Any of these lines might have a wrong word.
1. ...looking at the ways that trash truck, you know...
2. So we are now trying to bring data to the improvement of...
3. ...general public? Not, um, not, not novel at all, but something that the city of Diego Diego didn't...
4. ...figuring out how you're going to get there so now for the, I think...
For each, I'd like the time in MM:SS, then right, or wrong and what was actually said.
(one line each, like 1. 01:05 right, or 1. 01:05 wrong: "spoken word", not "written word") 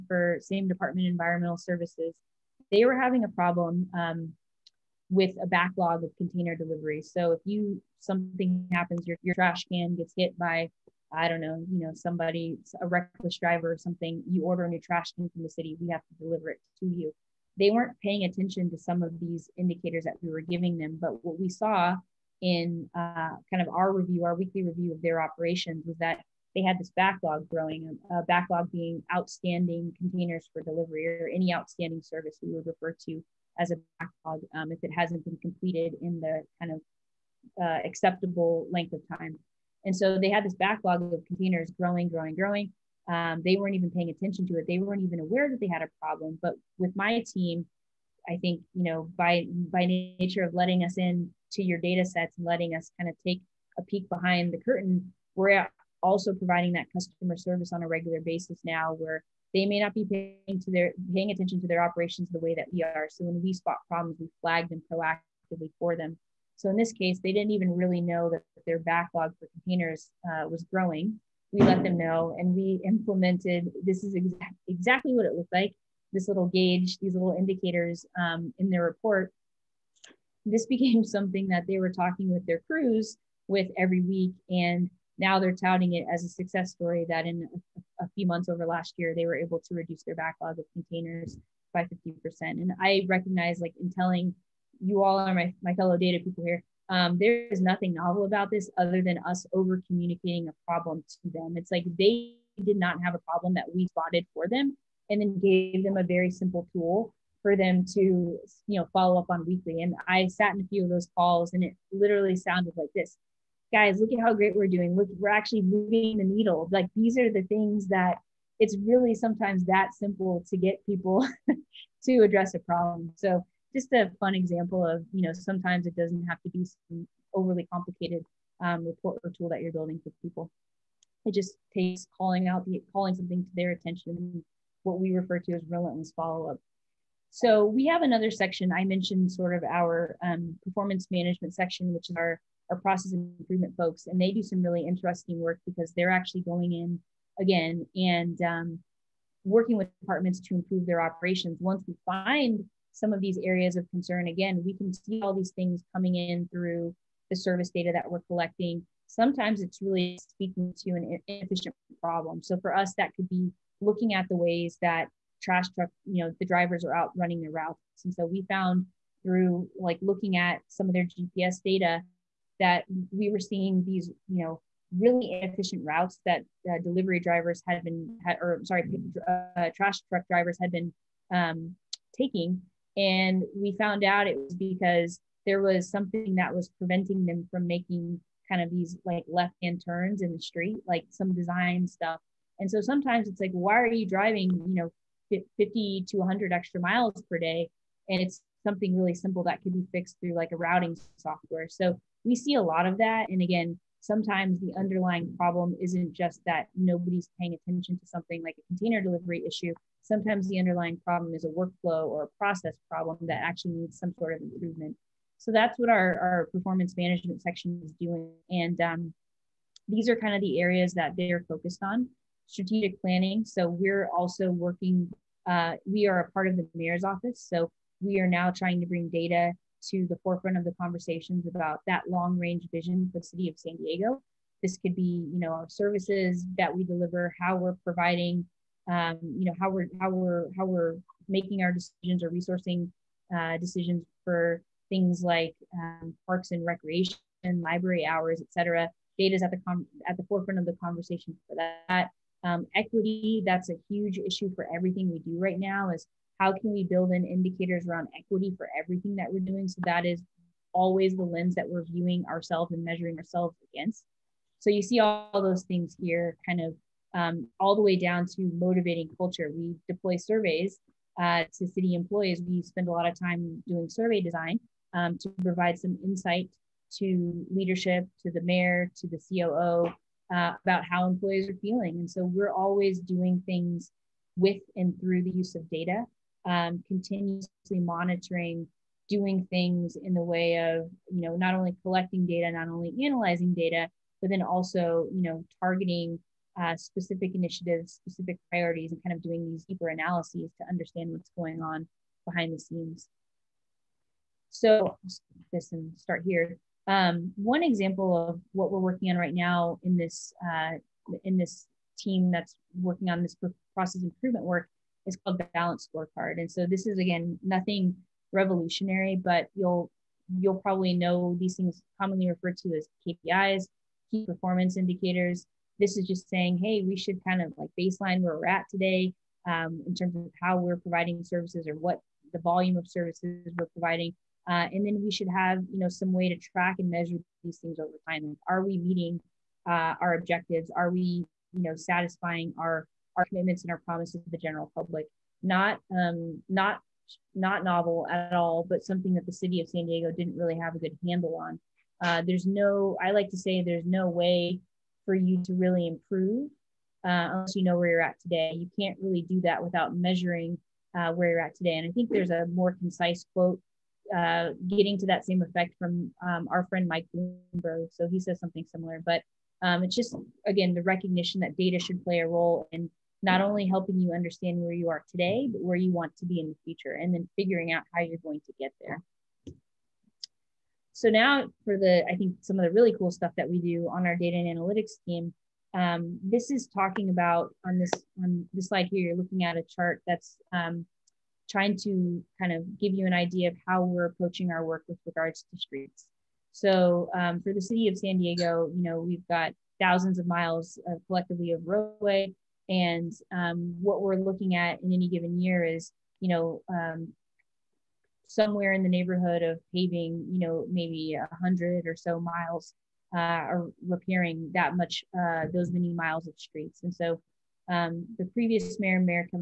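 1. 02:43 right
2. 03:47 wrong: "forefront", not "improvement"
3. 05:44 wrong: "San", not "Diego"
4. 06:17 right.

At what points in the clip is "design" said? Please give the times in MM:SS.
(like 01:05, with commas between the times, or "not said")
03:11, 04:34.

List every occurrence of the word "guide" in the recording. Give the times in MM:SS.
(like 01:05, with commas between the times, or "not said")
not said.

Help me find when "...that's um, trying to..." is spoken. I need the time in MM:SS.
06:30.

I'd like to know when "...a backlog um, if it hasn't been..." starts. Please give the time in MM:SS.
00:33.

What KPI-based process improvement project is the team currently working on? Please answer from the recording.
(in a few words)
balance scorecard.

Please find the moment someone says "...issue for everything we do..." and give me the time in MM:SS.
04:14.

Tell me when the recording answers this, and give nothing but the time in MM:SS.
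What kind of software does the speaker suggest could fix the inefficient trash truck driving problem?
03:20.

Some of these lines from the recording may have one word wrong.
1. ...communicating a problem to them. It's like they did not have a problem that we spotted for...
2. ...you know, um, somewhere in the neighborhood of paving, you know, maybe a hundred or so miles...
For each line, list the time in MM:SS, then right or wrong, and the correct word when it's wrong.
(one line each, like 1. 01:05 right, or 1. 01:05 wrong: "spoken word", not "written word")
1. 01:39 right
2. 06:46 right.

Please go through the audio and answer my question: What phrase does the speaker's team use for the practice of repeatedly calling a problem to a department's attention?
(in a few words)
relentless follow-up.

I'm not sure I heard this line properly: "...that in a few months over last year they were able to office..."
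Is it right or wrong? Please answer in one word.
wrong.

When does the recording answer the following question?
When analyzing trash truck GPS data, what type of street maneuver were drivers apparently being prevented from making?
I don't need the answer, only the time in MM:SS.
03:09.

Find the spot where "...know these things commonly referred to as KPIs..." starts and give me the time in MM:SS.
05:20.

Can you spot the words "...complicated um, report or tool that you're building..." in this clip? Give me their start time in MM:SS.
02:07.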